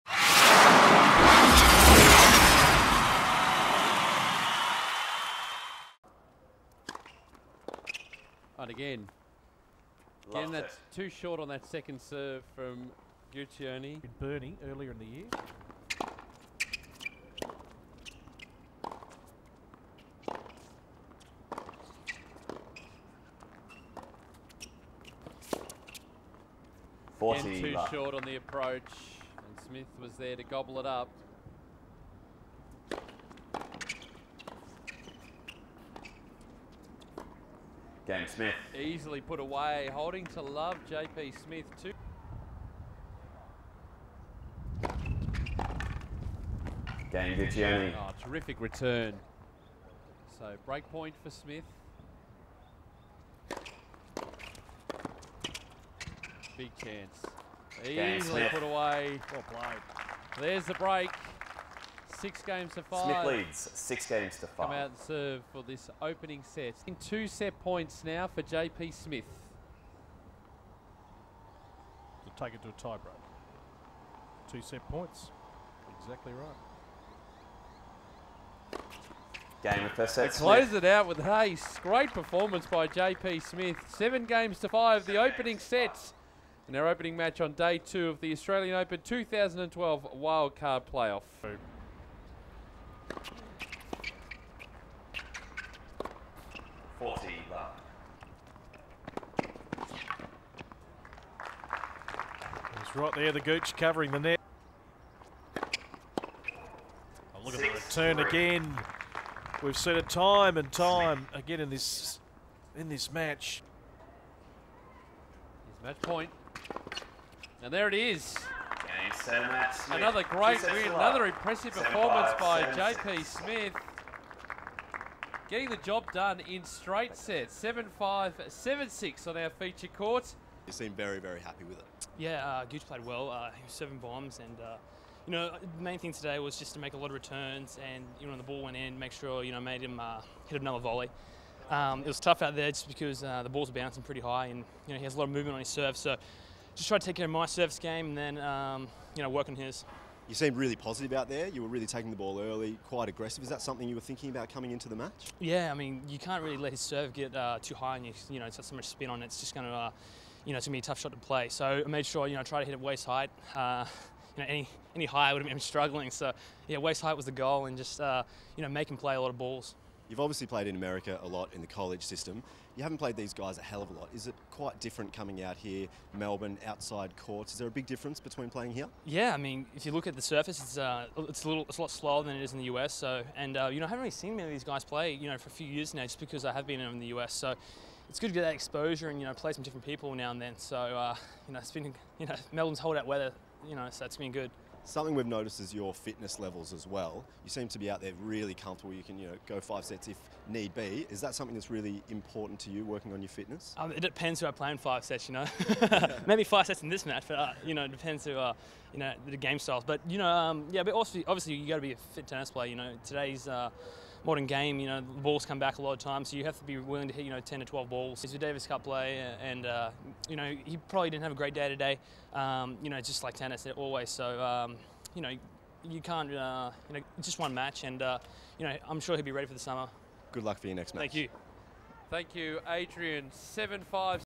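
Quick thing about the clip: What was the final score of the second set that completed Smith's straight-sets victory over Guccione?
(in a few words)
7-6.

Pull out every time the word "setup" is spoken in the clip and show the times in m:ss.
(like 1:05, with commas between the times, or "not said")
not said.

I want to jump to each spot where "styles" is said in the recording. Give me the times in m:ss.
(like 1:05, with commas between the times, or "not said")
3:29.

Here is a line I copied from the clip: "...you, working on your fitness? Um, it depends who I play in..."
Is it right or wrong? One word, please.
right.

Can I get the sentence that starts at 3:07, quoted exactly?
So it's good to get that exposure and you know play some different people now and then.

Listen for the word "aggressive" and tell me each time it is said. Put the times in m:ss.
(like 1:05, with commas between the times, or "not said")
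2:33.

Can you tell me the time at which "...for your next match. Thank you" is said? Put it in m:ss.
3:50.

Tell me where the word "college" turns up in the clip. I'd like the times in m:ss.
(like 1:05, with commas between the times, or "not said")
2:51.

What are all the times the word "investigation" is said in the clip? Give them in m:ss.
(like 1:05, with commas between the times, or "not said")
not said.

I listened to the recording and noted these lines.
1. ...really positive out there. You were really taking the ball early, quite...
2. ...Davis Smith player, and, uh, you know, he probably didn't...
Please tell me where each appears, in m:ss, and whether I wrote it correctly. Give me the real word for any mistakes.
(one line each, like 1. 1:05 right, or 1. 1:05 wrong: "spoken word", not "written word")
1. 2:30 right
2. 3:38 wrong: "Cup", not "Smith".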